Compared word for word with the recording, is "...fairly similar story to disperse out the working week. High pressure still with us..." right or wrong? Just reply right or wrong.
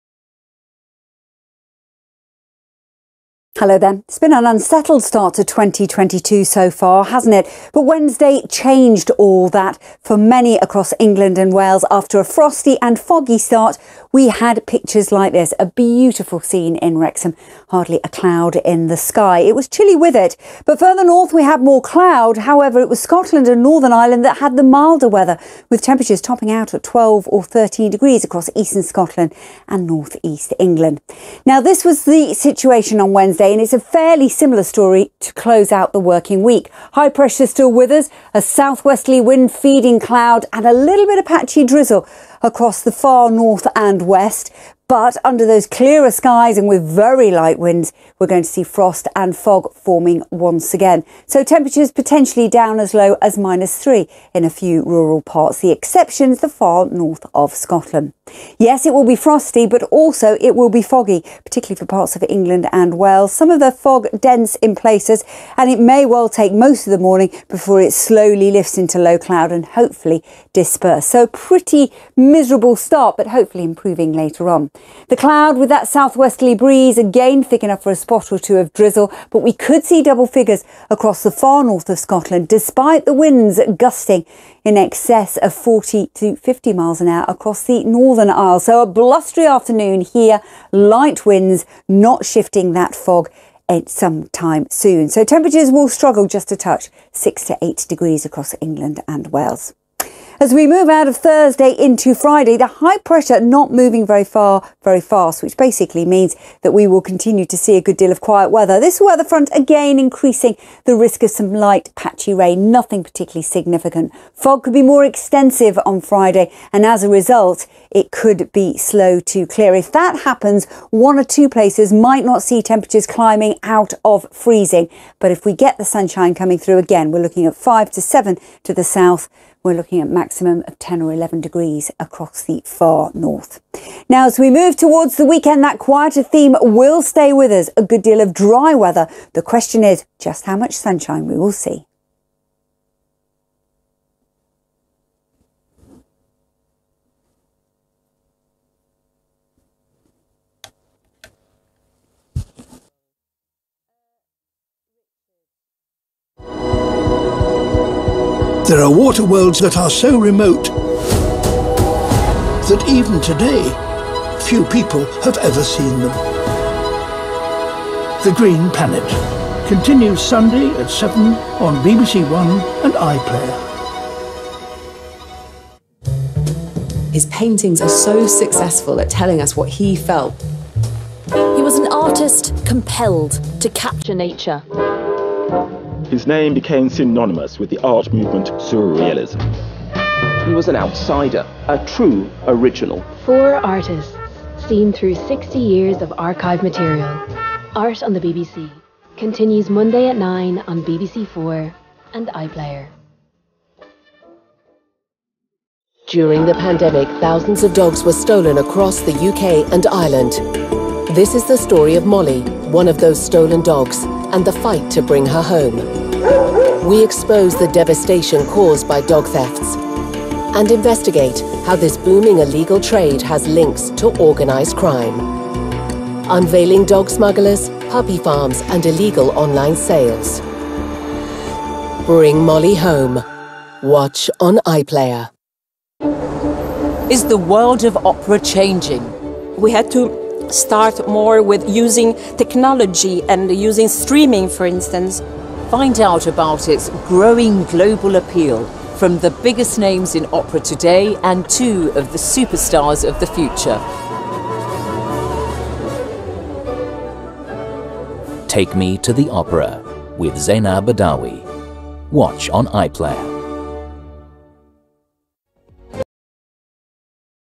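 wrong.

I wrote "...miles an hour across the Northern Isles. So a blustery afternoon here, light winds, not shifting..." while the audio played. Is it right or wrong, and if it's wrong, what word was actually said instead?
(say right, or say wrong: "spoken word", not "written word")
right.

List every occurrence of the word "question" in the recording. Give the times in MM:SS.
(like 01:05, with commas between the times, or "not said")
02:19.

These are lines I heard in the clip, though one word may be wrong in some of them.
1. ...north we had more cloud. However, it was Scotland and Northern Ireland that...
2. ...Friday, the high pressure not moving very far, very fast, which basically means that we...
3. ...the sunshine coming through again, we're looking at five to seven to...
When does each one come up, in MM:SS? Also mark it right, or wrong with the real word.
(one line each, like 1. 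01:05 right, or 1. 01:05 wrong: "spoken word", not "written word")
1. 00:21 right
2. 01:42 right
3. 02:05 right.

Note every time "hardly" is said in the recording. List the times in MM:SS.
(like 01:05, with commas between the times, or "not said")
00:17.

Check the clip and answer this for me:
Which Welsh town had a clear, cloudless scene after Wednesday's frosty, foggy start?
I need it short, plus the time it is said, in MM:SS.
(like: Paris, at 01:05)
Wrexham, at 00:16.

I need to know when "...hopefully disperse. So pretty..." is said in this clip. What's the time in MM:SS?
01:09.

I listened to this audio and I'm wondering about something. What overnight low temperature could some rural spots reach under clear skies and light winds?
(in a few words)
-3.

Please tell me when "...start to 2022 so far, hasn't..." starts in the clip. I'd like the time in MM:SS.
00:05.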